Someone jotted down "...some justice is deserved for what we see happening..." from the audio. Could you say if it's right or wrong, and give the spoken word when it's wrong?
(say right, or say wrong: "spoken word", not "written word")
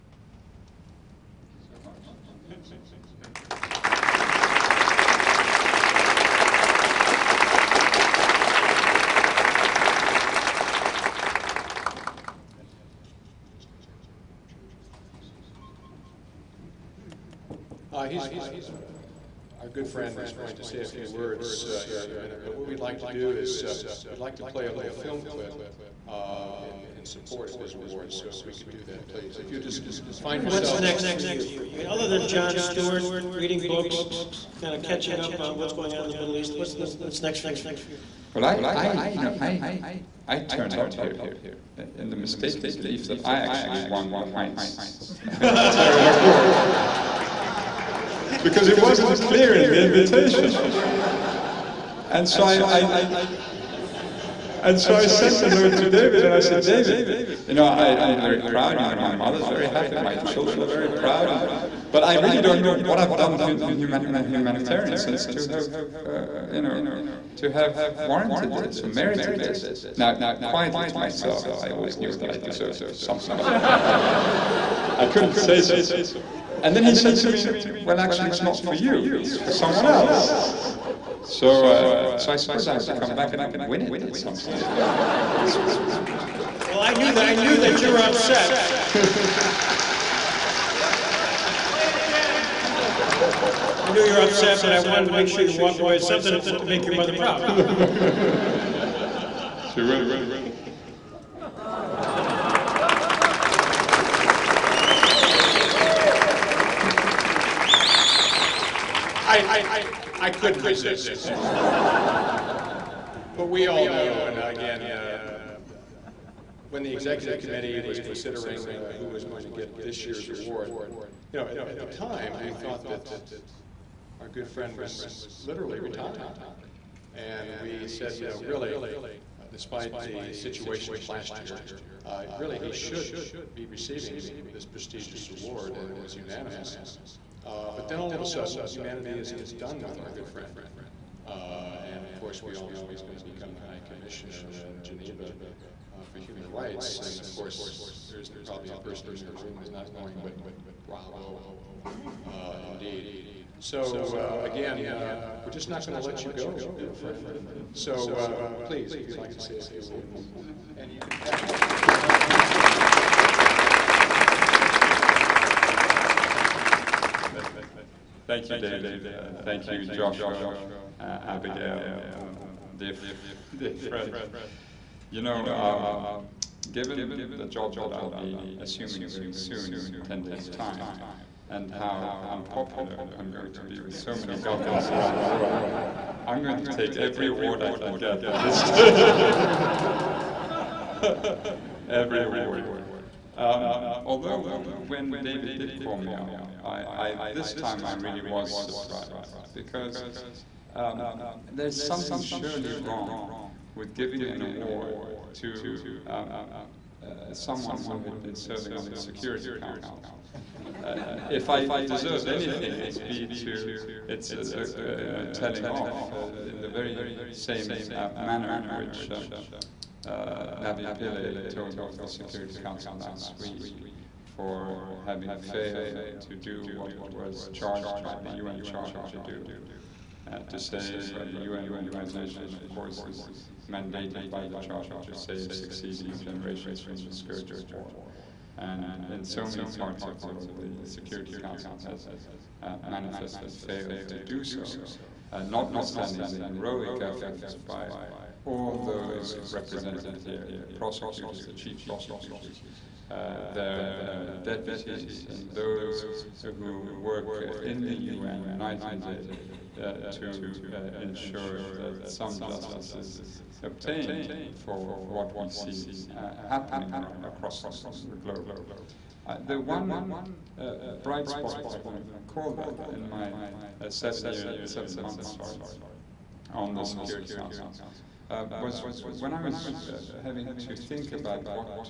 wrong: "obtained", not "deserved".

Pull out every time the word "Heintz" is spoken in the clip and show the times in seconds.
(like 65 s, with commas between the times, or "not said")
44 s.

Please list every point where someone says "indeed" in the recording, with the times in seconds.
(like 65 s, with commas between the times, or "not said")
152 s.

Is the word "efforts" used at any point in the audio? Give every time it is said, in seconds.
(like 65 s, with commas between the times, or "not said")
246 s.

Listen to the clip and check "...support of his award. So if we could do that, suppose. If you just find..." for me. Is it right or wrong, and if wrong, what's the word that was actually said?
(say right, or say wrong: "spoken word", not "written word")
wrong: "please", not "suppose".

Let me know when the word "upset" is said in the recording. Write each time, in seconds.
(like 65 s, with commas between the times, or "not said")
87 s, 94 s.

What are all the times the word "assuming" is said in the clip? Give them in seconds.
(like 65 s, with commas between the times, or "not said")
178 s.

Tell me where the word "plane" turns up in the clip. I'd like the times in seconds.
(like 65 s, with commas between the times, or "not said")
not said.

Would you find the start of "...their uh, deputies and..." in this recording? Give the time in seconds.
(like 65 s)
253 s.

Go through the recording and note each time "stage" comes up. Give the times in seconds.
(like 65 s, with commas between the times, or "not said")
84 s, 190 s.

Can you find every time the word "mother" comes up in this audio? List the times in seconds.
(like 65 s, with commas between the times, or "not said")
59 s, 96 s.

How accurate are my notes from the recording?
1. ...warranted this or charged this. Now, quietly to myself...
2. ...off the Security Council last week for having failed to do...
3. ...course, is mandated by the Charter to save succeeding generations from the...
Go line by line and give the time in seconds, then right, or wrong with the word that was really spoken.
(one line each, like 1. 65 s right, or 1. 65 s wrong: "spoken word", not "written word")
1. 68 s wrong: "merited", not "charged"
2. 221 s right
3. 232 s right.